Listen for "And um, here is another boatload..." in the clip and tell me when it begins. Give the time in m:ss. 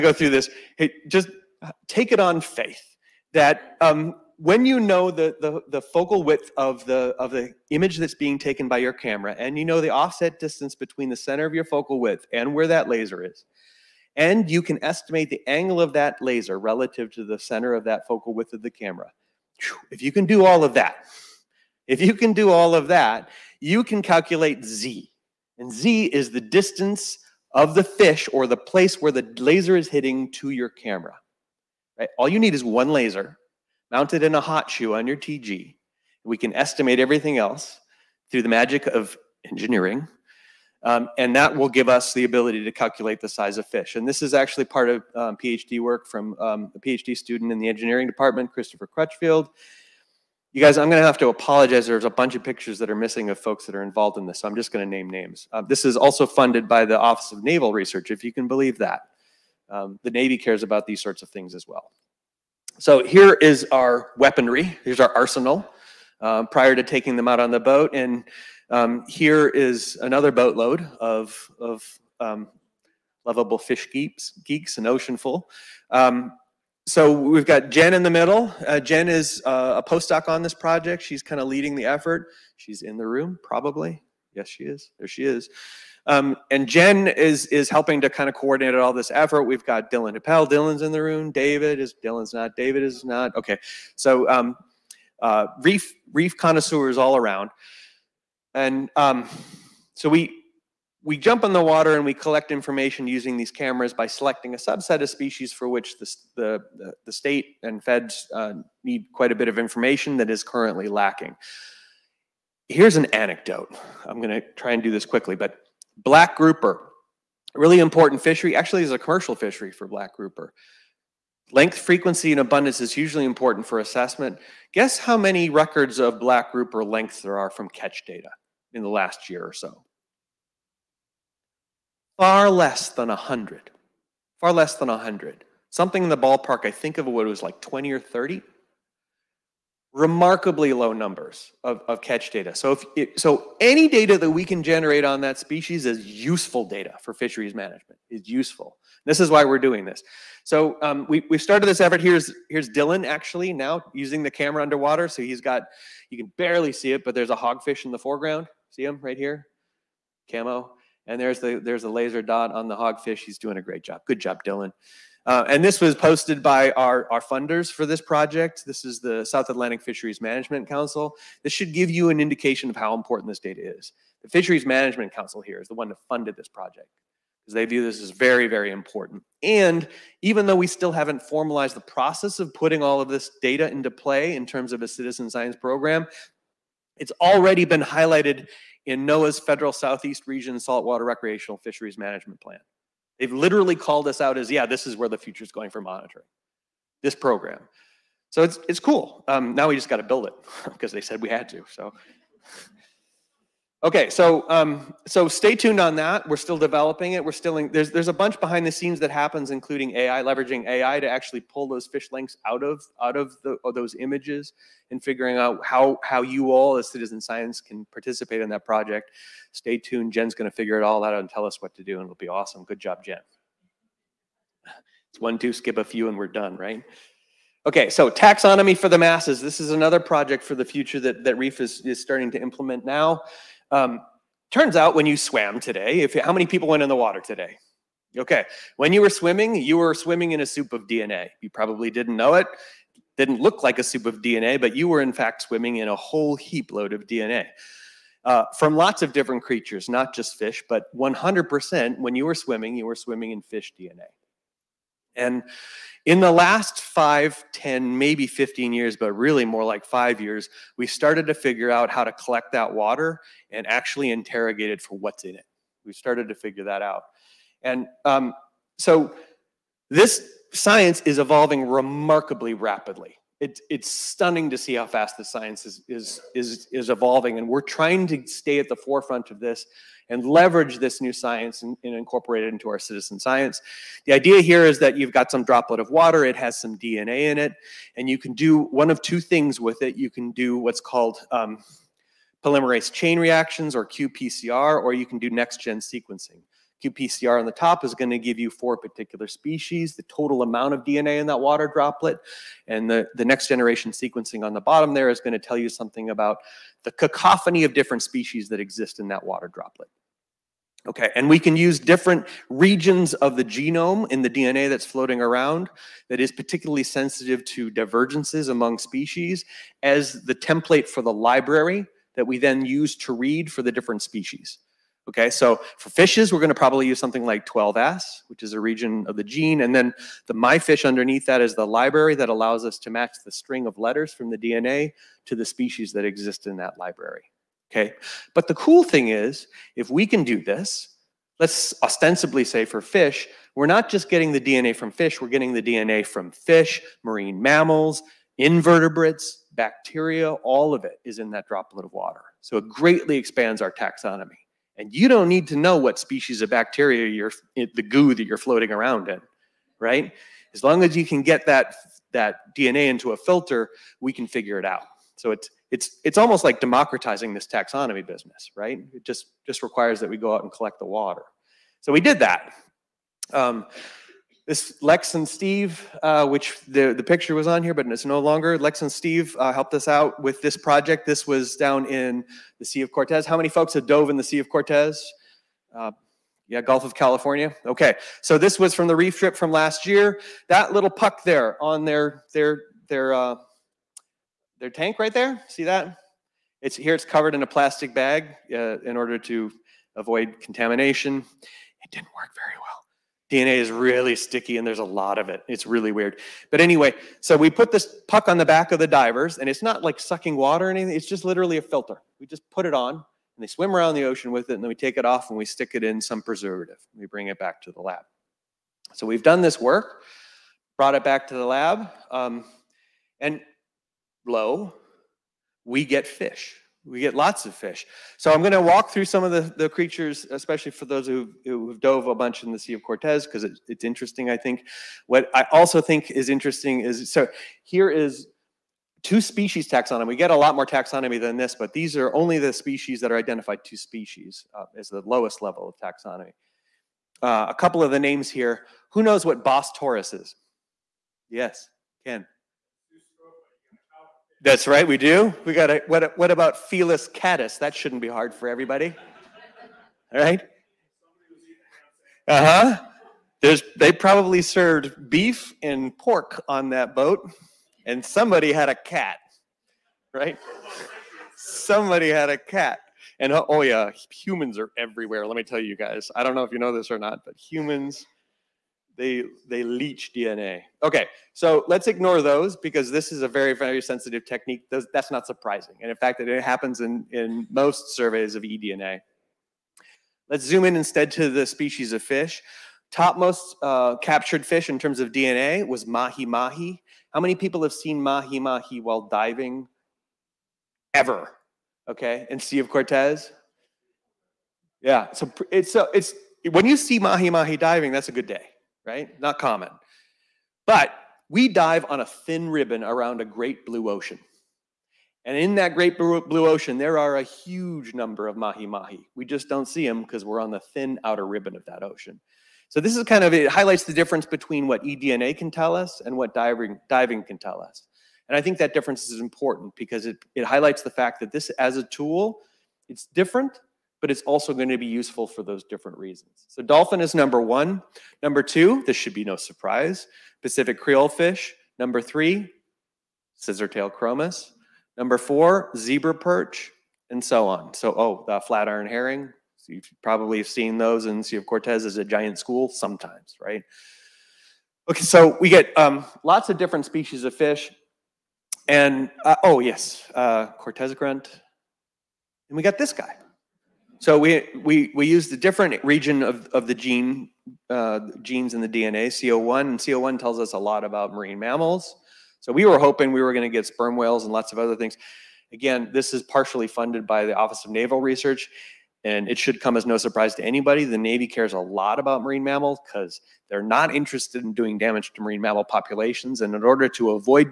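1:07.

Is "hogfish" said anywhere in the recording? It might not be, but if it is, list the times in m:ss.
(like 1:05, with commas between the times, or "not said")
2:37, 2:42.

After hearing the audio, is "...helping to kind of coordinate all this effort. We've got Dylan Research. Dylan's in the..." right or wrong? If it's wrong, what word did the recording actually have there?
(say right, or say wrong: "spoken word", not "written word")
wrong: "Appel", not "Research".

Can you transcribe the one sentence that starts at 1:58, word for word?
Actually, is a commercial fishery for black grouper.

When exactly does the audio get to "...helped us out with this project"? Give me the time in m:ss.
6:19.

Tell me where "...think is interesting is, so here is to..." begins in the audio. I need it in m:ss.
7:15.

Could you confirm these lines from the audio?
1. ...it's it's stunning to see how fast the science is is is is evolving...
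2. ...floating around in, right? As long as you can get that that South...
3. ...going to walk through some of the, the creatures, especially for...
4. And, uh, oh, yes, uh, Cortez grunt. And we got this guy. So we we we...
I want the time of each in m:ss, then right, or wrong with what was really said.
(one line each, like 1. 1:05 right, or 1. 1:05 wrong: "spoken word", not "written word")
1. 4:33 right
2. 5:58 wrong: "DNA", not "South"
3. 7:08 right
4. 9:18 right.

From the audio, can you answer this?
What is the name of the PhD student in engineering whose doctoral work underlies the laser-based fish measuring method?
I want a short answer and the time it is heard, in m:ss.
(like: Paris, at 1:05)
Christopher Crutchfield, at 0:48.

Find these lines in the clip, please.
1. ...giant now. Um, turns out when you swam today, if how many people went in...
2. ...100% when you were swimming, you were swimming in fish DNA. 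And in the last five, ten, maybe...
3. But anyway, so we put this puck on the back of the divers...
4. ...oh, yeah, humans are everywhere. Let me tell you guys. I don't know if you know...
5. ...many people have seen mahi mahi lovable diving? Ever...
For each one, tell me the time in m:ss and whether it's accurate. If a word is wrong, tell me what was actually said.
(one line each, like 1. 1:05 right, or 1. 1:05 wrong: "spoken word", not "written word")
1. 3:52 wrong: "implement", not "giant"
2. 4:10 right
3. 6:46 right
4. 7:53 right
5. 8:17 wrong: "while", not "lovable".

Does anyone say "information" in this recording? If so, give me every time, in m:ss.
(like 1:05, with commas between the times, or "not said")
1:42, 1:49.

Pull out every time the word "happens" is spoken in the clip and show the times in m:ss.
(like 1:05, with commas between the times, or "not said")
3:29, 8:06.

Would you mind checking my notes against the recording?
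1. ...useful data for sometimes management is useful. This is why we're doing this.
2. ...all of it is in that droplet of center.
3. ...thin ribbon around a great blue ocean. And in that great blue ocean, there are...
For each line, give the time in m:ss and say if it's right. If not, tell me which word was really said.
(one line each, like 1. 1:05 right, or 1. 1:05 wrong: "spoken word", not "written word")
1. 2:26 wrong: "fisheries", not "sometimes"
2. 5:50 wrong: "water", not "center"
3. 8:32 right.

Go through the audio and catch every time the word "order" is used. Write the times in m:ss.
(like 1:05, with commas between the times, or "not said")
6:38, 9:46.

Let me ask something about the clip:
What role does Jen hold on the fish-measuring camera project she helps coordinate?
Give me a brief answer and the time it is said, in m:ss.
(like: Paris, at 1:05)
postdoc, at 1:19.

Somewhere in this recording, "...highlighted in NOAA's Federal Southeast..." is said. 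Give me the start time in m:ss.
3:07.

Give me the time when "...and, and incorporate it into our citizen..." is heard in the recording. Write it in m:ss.
4:41.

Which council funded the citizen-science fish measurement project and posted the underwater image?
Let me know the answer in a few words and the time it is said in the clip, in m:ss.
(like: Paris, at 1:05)
South Atlantic Fisheries Management Council, at 2:49.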